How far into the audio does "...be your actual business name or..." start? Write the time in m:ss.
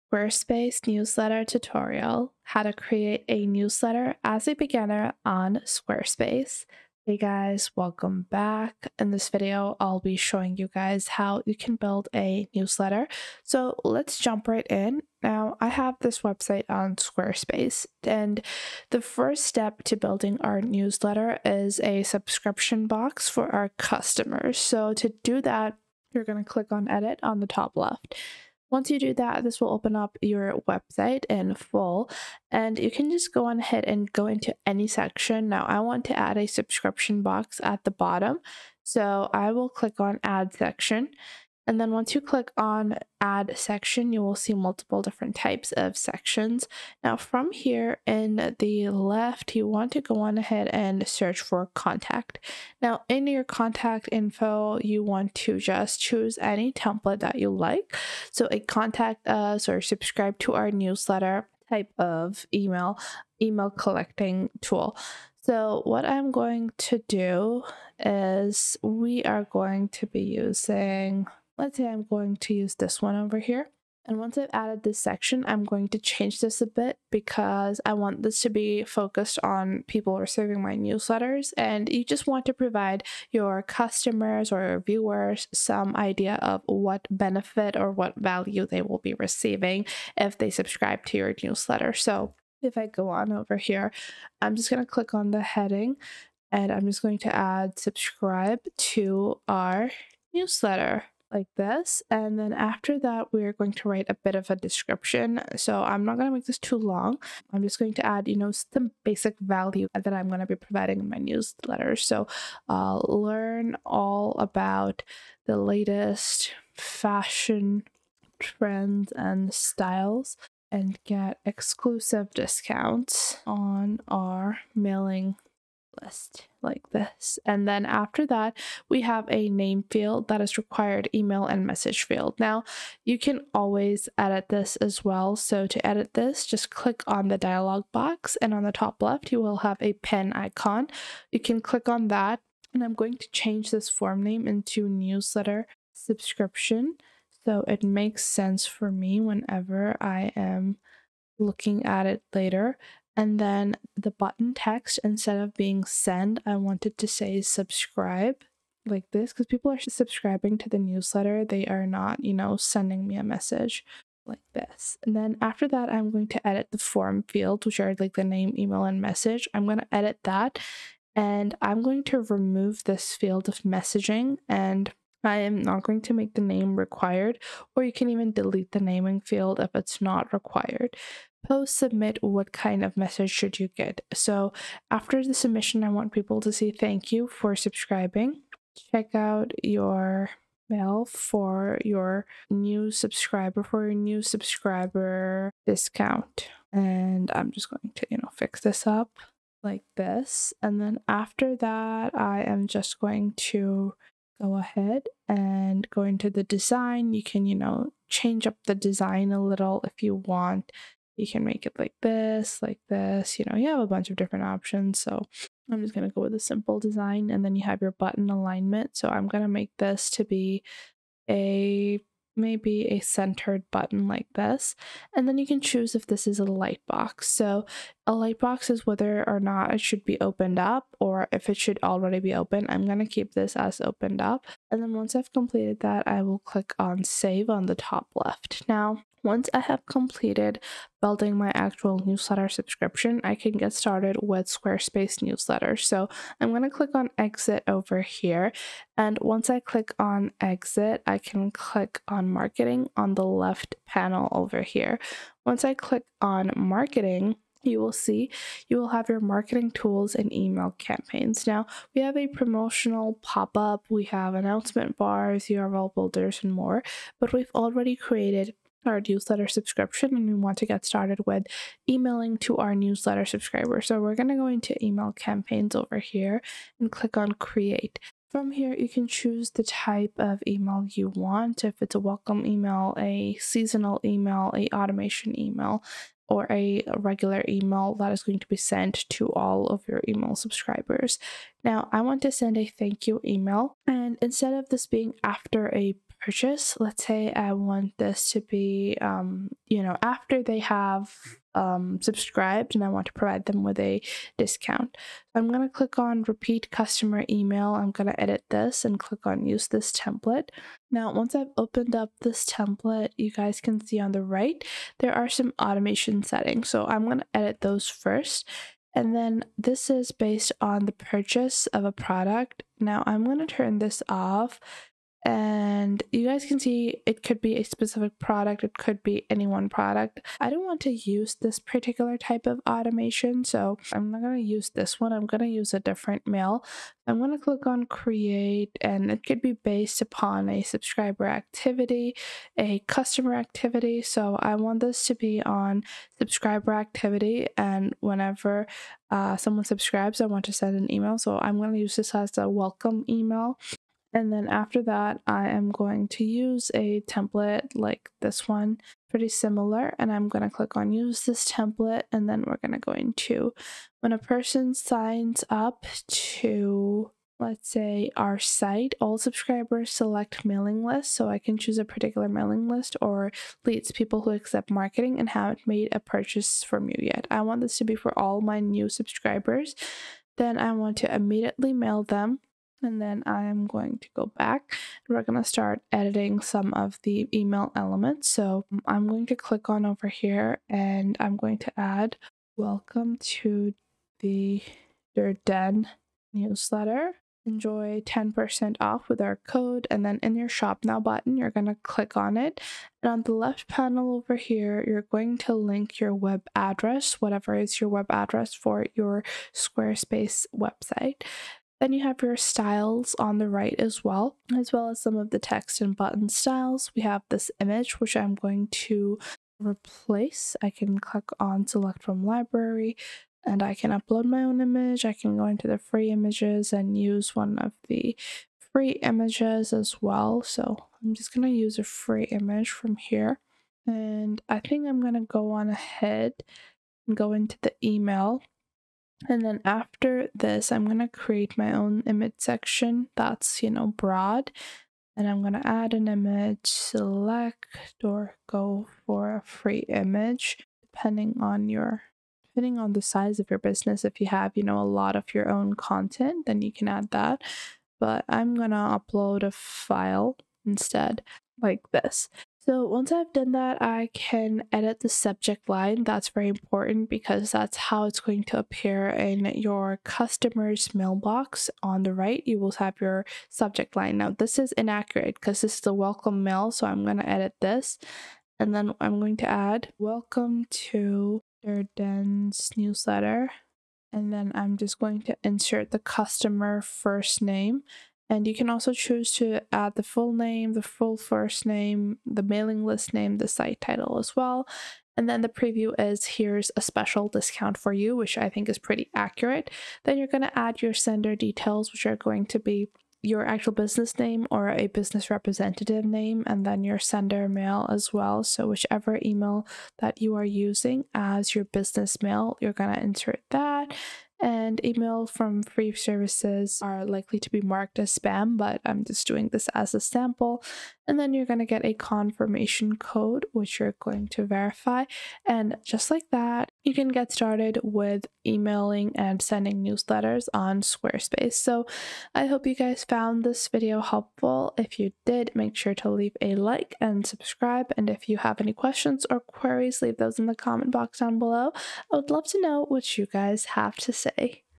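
8:22.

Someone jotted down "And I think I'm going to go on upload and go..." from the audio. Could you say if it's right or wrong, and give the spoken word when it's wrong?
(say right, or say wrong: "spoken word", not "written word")
wrong: "ahead", not "upload".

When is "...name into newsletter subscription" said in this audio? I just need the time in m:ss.
2:24.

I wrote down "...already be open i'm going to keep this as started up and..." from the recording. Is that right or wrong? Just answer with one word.
wrong.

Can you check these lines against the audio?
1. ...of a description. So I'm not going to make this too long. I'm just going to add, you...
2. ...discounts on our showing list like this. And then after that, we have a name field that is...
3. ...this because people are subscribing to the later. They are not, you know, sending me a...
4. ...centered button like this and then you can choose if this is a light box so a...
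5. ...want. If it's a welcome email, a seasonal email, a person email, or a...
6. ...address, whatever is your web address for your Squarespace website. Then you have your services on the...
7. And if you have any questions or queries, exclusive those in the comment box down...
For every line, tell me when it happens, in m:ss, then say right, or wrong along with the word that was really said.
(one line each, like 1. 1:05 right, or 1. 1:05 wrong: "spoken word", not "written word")
1. 1:44 right
2. 2:02 wrong: "mailing", not "showing"
3. 2:39 wrong: "newsletter", not "later"
4. 3:43 right
5. 4:41 wrong: "automation", not "person"
6. 6:46 wrong: "styles", not "services"
7. 8:57 wrong: "leave", not "exclusive".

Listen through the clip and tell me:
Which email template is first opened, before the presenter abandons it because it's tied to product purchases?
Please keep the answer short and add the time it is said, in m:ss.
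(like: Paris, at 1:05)
repeat customer email, at 5:06.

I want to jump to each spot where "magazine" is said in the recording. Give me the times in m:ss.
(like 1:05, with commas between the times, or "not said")
not said.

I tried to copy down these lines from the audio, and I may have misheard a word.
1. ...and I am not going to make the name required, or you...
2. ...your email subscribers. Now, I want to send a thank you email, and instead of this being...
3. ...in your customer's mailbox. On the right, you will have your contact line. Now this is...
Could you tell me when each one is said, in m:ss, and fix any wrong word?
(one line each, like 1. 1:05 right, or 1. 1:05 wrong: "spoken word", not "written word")
1. 2:54 right
2. 4:49 right
3. 7:49 wrong: "subject", not "contact".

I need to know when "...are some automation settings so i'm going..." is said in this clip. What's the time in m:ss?
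5:15.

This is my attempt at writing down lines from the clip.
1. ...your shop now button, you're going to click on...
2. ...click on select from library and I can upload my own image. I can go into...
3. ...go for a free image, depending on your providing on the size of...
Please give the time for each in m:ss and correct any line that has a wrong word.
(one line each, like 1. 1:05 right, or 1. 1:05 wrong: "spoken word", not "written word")
1. 6:40 right
2. 7:00 right
3. 7:28 wrong: "depending", not "providing".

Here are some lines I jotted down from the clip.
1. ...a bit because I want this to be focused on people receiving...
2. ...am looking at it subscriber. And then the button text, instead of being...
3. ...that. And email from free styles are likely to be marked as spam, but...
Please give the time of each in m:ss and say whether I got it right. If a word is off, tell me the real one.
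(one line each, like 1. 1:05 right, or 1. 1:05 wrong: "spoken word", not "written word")
1. 1:16 right
2. 2:30 wrong: "later", not "subscriber"
3. 8:33 wrong: "services", not "styles".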